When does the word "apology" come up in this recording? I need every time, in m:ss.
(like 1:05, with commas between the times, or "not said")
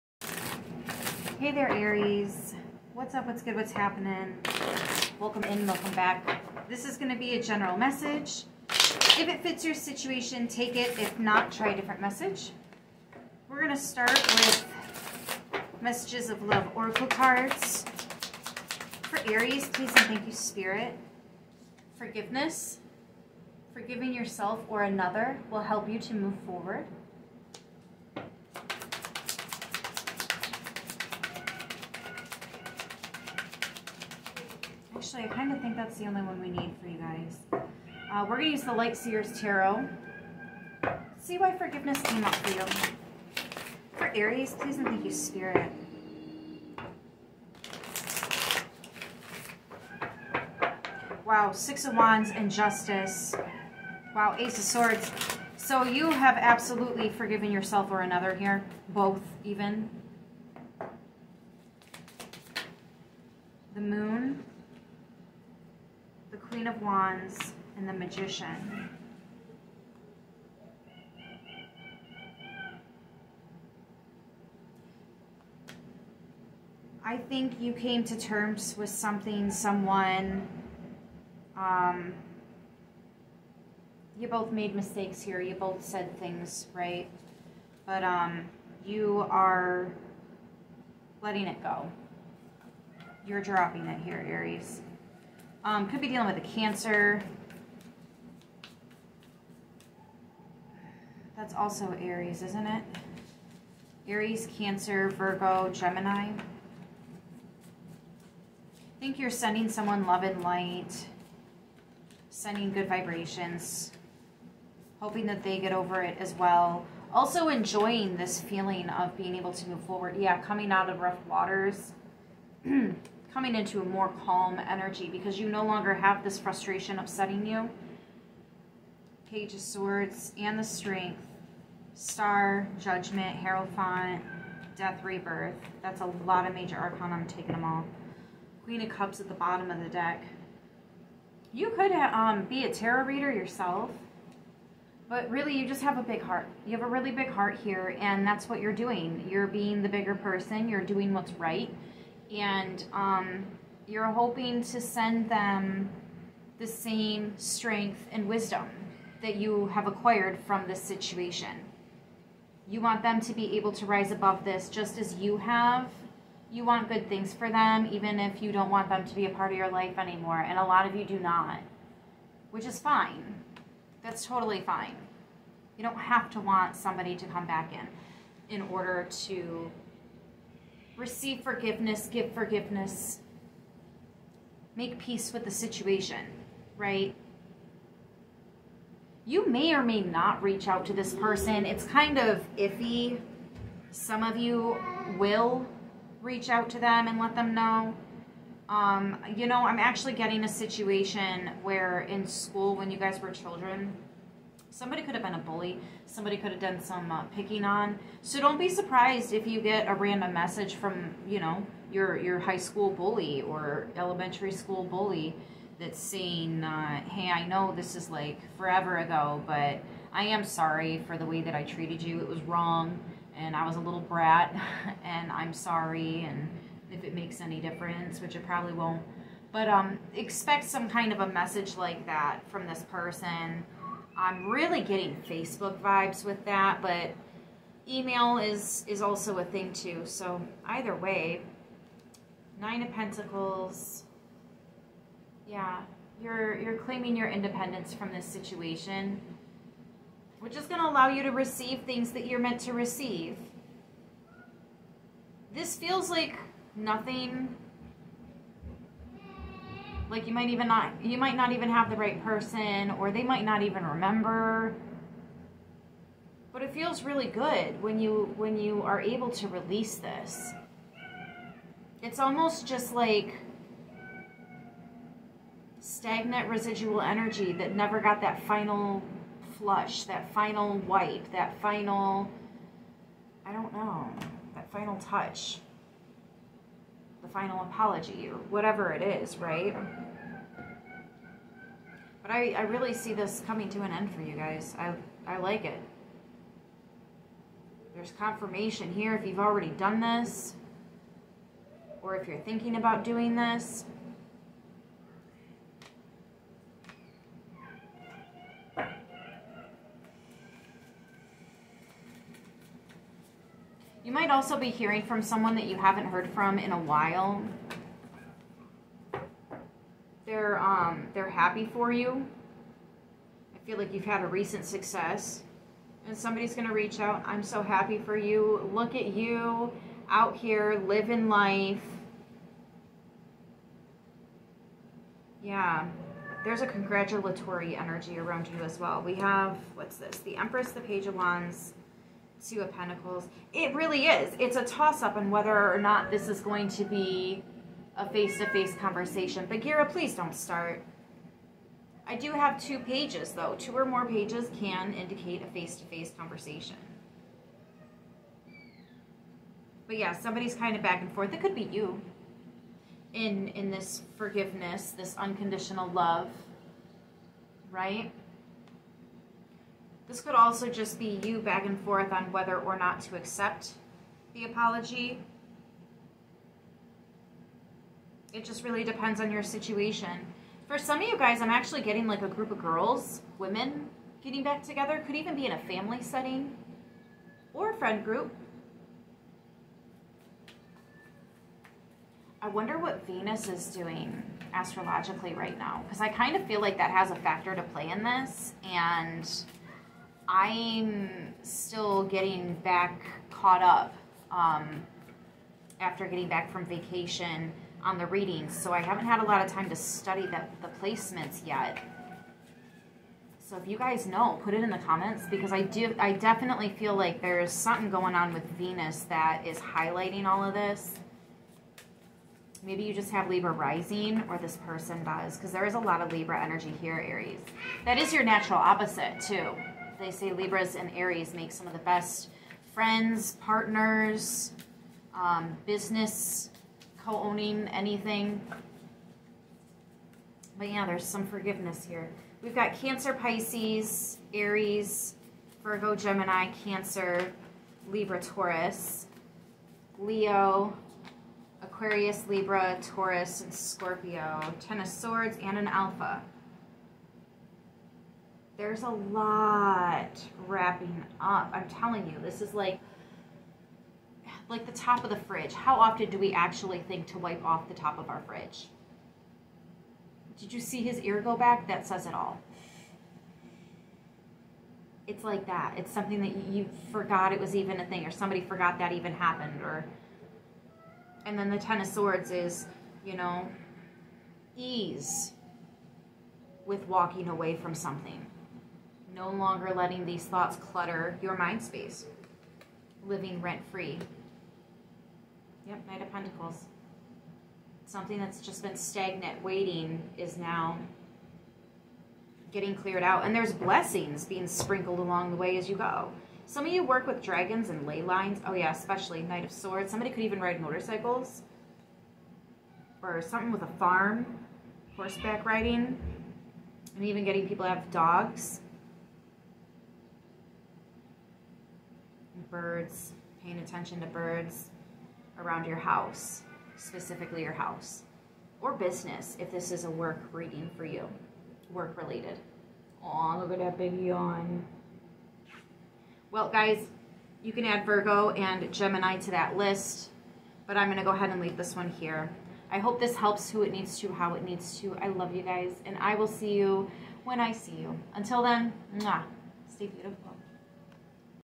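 4:47, 6:14.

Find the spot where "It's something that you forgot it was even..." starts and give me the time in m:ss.
7:55.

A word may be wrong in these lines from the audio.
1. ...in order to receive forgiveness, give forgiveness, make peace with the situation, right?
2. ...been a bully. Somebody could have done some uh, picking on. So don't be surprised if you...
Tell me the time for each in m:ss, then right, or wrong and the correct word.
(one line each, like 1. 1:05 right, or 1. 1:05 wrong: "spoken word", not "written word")
1. 2:58 right
2. 3:25 right.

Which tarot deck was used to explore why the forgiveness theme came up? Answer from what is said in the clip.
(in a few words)
Light Seers Tarot.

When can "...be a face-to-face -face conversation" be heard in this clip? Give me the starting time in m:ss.
5:46.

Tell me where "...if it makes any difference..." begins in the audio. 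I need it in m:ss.
3:46.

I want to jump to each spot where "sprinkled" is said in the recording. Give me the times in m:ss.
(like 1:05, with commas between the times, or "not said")
8:24.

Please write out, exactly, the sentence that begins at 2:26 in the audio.
You have a really big heart here, and that's what you're doing.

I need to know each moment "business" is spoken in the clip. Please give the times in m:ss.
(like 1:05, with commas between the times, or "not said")
7:15, 8:48.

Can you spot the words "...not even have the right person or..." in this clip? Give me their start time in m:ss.
4:21.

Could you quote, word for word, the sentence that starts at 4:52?
But I, I really see this coming to an end for you guys.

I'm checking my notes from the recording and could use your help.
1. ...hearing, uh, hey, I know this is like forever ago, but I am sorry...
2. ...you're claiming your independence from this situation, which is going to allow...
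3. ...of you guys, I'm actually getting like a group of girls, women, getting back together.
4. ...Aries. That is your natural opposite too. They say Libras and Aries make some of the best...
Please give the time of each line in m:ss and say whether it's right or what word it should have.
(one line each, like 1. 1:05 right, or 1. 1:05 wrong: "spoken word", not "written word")
1. 3:35 wrong: "saying", not "hearing"
2. 4:06 right
3. 6:21 right
4. 7:07 right.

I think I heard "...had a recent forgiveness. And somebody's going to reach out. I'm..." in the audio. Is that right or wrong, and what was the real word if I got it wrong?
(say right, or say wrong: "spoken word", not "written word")
wrong: "success", not "forgiveness".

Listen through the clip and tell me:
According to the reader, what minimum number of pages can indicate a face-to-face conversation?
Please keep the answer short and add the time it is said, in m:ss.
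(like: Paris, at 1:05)
2, at 5:53.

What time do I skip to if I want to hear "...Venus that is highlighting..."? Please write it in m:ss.
6:58.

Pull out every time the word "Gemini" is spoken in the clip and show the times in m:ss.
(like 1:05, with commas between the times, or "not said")
1:45, 7:25, 8:58.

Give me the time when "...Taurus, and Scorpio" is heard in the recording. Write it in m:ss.
7:32.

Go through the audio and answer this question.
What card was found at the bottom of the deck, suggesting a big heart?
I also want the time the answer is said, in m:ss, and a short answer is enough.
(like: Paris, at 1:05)
Queen of Cups, at 2:18.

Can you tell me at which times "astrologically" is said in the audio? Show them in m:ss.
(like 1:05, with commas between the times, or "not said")
6:34.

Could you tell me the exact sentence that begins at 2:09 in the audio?
Page of Swords and the Strength, Star, Judgment, Hierophant, Death, Rebirth.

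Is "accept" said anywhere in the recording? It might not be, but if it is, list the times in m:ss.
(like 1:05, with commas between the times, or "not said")
6:13.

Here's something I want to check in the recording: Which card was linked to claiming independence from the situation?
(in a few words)
Nine of Pentacles.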